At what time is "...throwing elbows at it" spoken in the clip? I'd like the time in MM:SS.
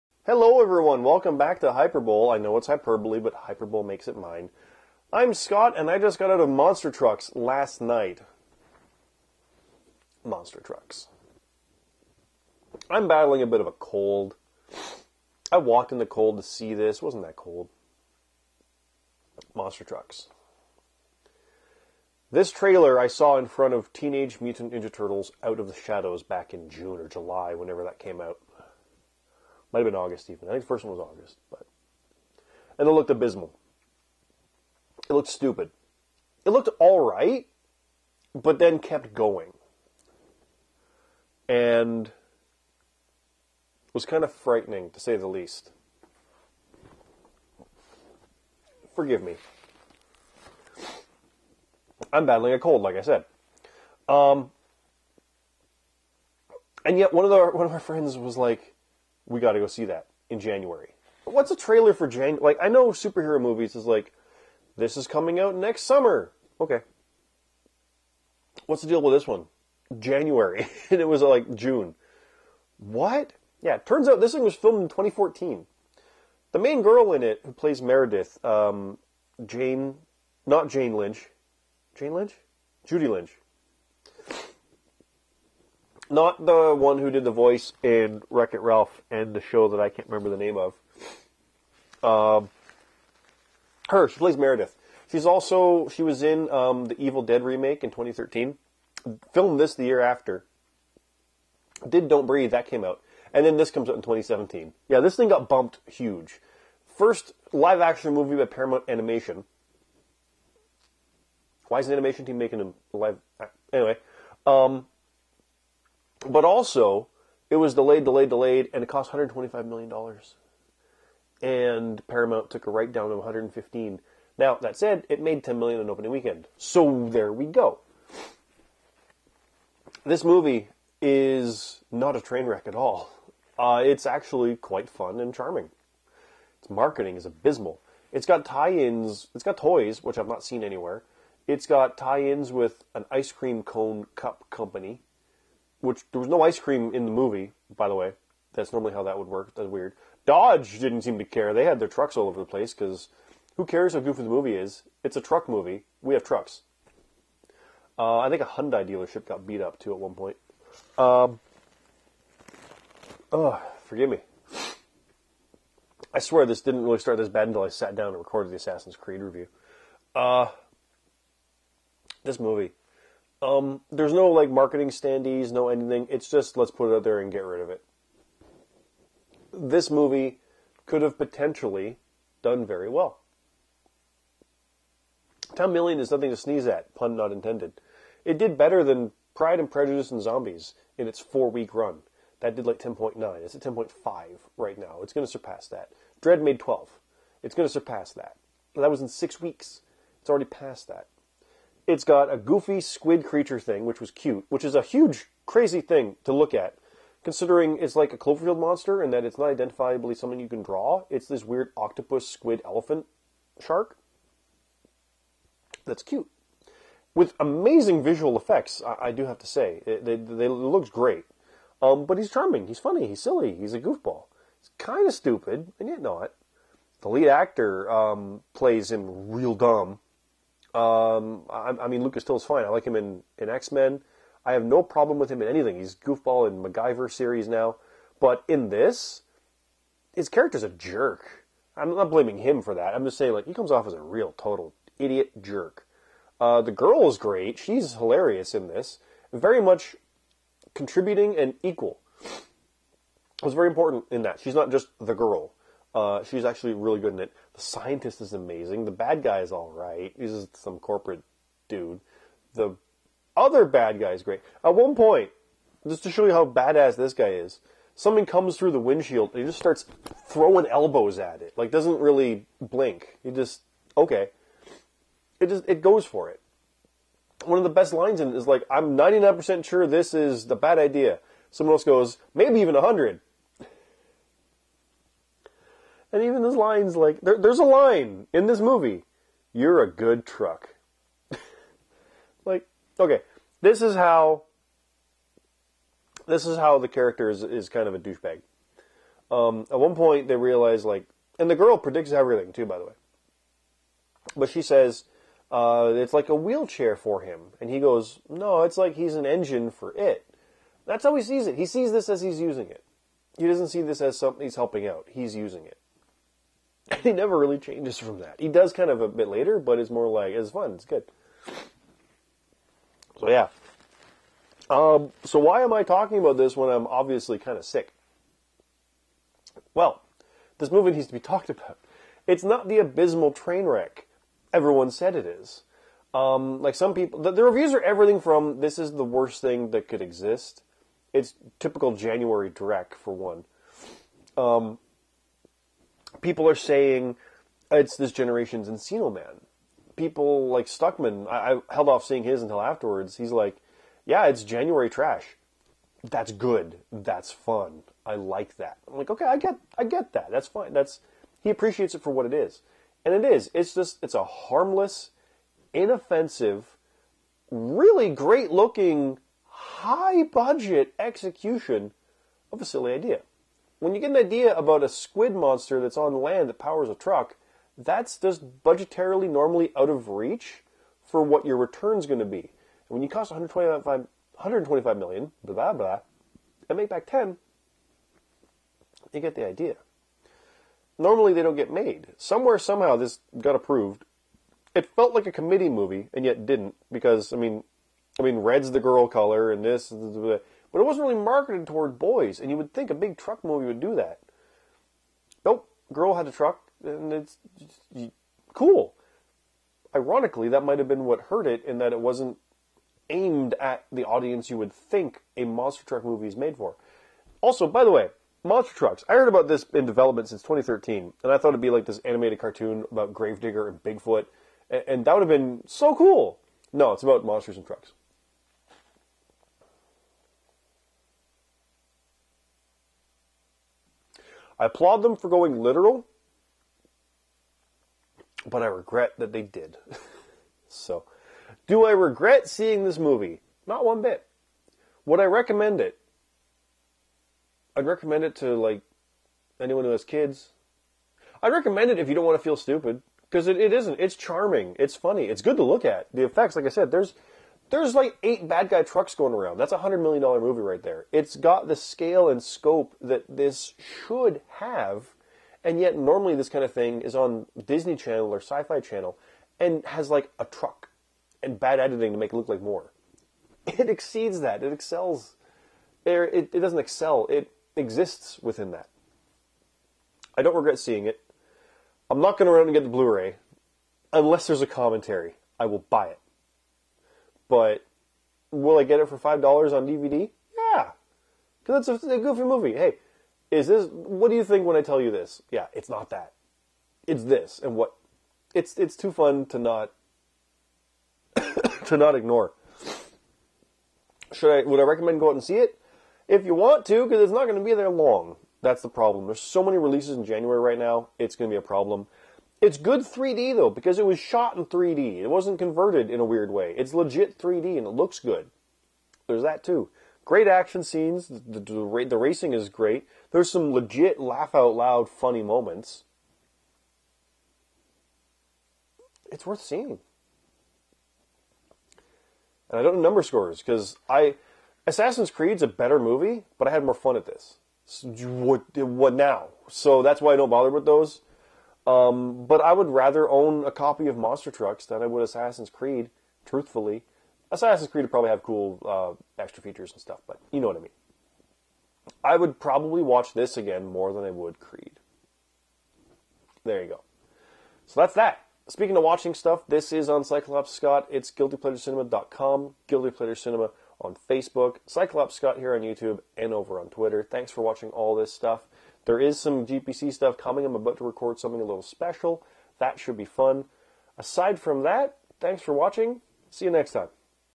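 04:30.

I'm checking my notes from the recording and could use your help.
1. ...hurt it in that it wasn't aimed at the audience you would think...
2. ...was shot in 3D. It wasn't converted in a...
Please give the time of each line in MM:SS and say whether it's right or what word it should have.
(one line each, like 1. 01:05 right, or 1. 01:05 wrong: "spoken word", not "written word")
1. 06:51 right
2. 08:34 right.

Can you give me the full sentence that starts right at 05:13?
He doesn't see this as something he's helping out.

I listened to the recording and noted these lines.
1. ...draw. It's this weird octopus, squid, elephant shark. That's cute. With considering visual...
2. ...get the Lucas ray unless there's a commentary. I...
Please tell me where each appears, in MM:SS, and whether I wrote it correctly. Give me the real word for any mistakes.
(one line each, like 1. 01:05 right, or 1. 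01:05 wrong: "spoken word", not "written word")
1. 03:30 wrong: "amazing", not "considering"
2. 08:02 wrong: "Blu", not "Lucas".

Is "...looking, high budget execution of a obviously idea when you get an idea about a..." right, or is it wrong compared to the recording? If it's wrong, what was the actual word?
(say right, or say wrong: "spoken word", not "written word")
wrong: "silly", not "obviously".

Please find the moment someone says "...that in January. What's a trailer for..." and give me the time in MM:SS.
00:59.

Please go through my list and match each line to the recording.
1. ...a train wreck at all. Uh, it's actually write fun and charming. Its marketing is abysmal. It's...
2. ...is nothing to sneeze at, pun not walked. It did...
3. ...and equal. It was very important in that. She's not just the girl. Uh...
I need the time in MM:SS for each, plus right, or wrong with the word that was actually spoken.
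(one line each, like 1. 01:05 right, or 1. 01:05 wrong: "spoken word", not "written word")
1. 02:12 wrong: "quite", not "write"
2. 03:05 wrong: "intended", not "walked"
3. 04:11 right.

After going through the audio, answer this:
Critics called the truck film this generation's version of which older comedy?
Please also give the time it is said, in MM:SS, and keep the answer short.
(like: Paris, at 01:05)
Encino Man, at 05:48.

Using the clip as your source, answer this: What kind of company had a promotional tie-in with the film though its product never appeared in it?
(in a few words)
ice cream cone cup company.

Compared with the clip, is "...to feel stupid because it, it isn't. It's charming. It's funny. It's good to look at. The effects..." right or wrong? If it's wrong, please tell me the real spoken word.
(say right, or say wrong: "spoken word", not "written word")
right.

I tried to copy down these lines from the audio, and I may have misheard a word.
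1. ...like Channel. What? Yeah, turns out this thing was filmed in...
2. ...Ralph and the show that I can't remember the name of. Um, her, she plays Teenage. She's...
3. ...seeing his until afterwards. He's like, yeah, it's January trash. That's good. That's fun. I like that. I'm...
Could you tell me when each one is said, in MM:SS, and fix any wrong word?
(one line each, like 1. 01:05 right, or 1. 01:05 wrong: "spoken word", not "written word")
1. 01:11 wrong: "June", not "Channel"
2. 01:28 wrong: "Meredith", not "Teenage"
3. 05:52 right.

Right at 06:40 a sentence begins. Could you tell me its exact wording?
But it wasn't really marketed toward boys, and you would think a big truck movie would do that.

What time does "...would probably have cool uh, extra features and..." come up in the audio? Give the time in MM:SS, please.
09:08.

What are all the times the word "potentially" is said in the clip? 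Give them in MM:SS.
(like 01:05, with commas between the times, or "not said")
03:01.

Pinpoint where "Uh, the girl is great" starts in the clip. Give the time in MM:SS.
04:06.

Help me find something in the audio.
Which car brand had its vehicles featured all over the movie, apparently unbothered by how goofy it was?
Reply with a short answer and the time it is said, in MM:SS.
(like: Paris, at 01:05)
Dodge, at 02:30.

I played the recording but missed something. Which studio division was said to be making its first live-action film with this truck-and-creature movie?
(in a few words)
Paramount Animation.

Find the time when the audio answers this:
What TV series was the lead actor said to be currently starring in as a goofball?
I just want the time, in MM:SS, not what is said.
03:56.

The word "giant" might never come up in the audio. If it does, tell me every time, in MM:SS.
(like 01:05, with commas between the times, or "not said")
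not said.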